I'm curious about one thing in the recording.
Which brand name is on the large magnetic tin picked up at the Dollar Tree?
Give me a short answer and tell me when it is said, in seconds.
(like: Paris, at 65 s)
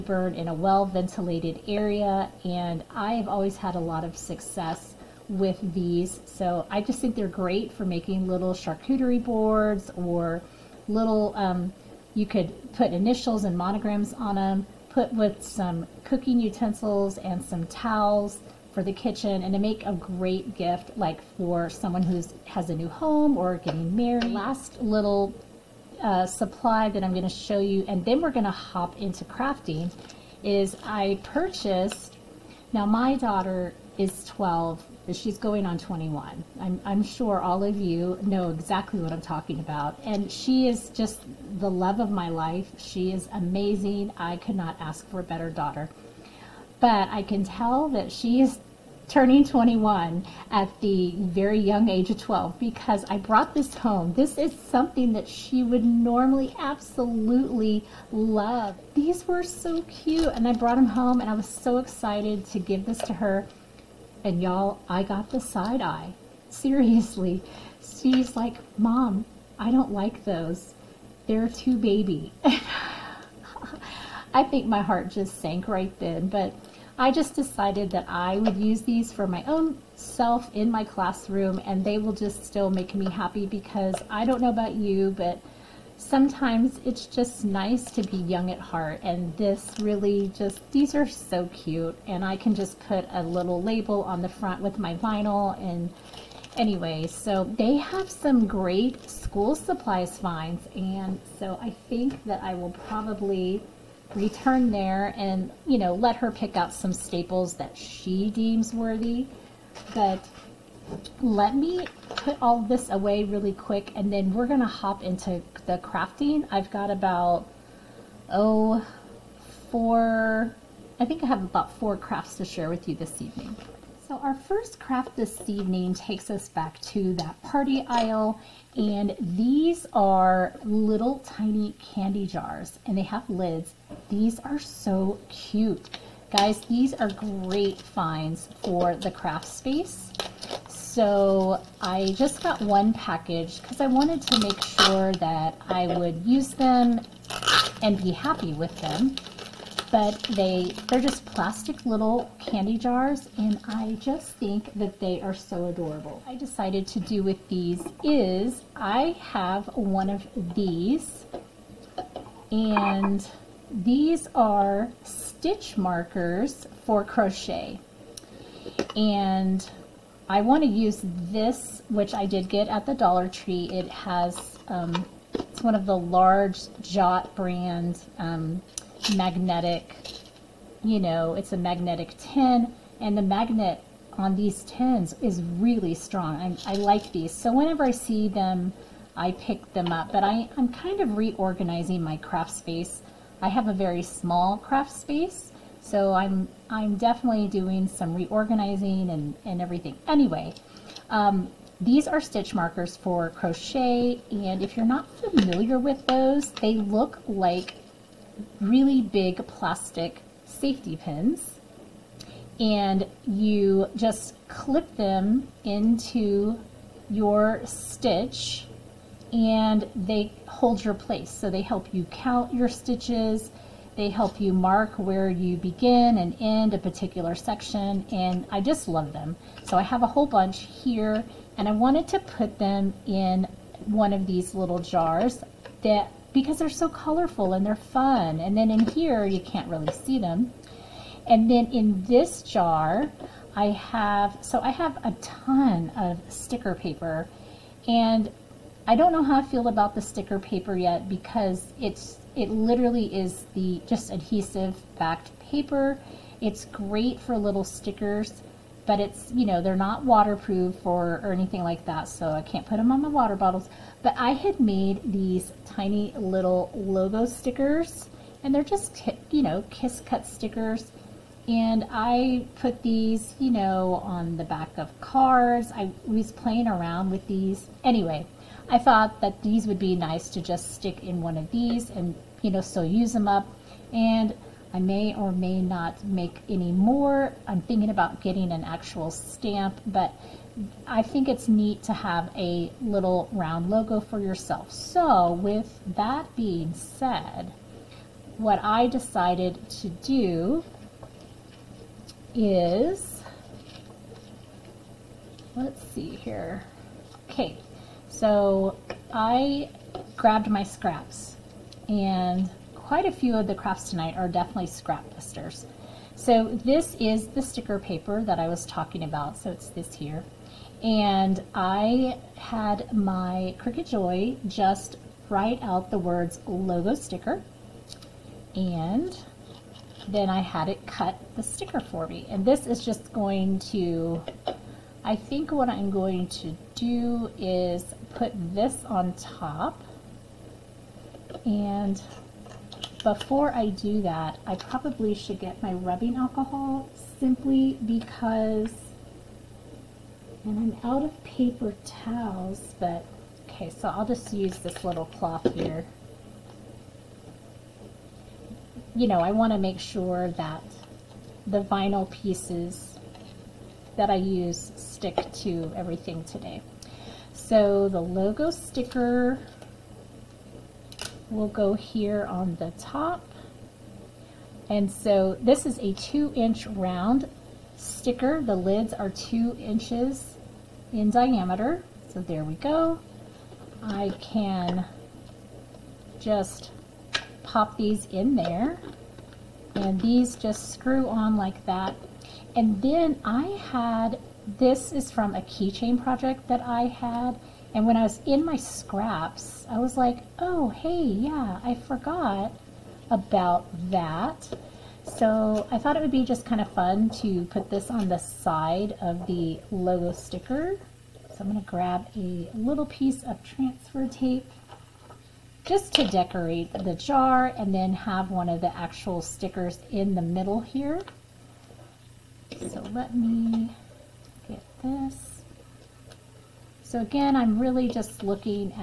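Jot, at 176 s.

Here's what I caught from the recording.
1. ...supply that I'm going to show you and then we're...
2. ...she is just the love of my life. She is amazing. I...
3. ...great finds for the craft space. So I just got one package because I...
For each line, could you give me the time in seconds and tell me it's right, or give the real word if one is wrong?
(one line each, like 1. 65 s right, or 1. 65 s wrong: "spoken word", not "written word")
1. 26 s right
2. 40 s right
3. 137 s right.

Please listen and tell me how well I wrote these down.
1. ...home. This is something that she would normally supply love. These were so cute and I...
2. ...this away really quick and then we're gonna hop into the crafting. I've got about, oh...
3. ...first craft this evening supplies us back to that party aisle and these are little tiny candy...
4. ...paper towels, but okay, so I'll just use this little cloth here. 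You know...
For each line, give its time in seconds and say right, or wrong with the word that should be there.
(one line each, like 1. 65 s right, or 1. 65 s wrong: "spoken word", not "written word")
1. 53 s wrong: "absolutely", not "supply"
2. 112 s right
3. 124 s wrong: "takes", not "supplies"
4. 351 s right.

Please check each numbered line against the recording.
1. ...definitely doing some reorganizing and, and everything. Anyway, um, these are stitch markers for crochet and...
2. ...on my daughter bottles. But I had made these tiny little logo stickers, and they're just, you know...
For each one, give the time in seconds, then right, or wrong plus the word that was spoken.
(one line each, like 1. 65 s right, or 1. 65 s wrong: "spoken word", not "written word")
1. 196 s right
2. 262 s wrong: "water", not "daughter".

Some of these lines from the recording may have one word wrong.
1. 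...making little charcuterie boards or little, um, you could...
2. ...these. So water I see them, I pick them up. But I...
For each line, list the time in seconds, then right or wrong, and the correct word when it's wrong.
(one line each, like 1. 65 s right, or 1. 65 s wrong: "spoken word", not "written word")
1. 7 s right
2. 187 s wrong: "whenever", not "water".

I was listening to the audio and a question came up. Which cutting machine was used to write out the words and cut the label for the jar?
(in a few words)
Cricut Joy.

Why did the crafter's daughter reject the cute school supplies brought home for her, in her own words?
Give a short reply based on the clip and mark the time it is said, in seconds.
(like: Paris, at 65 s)
too baby, at 71 s.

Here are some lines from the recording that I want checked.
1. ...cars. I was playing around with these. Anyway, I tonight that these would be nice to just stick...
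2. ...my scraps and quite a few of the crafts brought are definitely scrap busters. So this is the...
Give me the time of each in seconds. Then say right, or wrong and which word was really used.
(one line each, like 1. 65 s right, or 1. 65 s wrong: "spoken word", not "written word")
1. 275 s wrong: "thought", not "tonight"
2. 310 s wrong: "tonight", not "brought".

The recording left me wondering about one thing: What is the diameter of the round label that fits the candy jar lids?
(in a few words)
2 inches.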